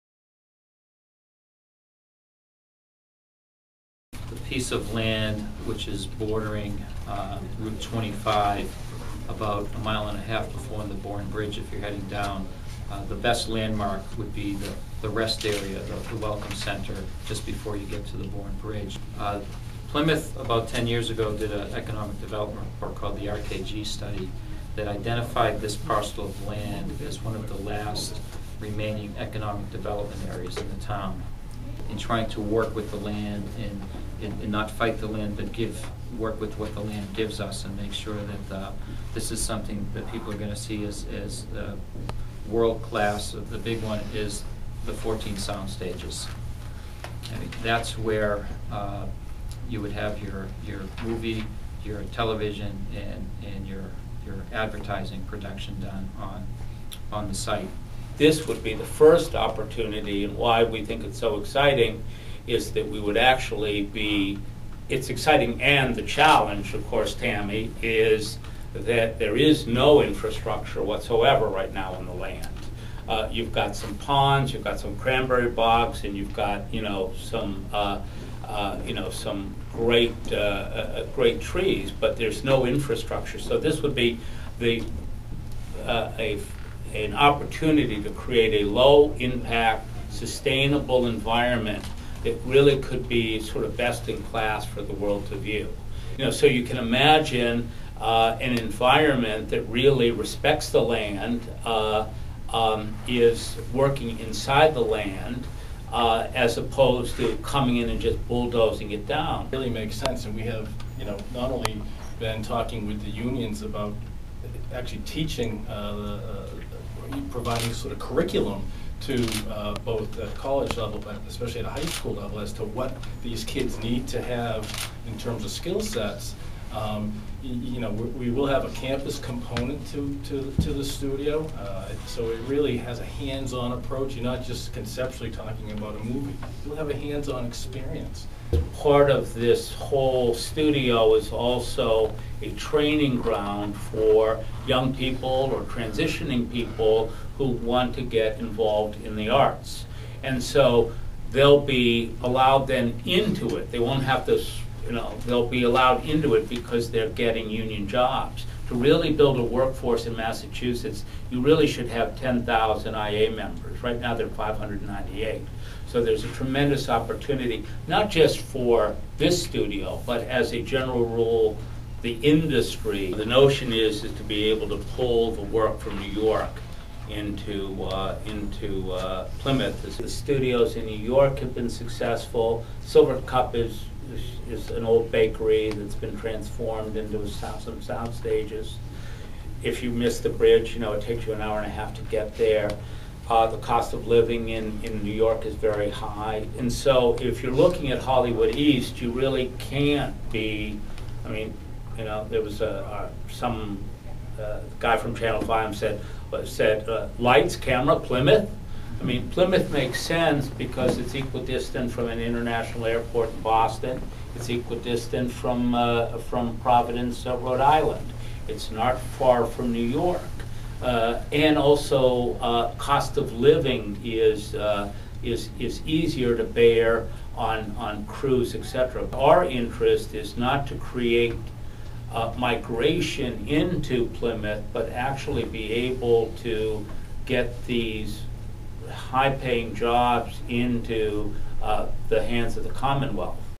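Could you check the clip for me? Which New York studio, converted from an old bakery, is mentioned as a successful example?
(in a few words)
Silvercup.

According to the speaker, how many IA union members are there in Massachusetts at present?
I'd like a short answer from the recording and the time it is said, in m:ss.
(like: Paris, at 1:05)
598, at 2:44.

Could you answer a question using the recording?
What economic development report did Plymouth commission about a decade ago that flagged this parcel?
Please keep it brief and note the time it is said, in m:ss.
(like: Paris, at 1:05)
RKG study, at 0:23.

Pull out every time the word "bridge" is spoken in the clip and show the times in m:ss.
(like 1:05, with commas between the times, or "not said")
0:11, 0:18, 3:10.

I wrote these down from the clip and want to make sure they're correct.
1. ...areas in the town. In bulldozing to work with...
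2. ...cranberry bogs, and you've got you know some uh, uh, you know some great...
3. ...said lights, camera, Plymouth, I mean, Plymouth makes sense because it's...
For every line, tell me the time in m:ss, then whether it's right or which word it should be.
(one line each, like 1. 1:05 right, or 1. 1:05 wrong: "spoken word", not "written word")
1. 0:30 wrong: "trying", not "bulldozing"
2. 1:14 right
3. 3:26 right.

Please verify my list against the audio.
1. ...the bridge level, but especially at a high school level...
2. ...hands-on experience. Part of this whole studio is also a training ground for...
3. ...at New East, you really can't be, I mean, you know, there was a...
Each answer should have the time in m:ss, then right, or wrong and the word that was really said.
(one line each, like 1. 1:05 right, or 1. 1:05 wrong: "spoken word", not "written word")
1. 2:00 wrong: "college", not "bridge"
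2. 2:16 right
3. 3:17 wrong: "Hollywood", not "New".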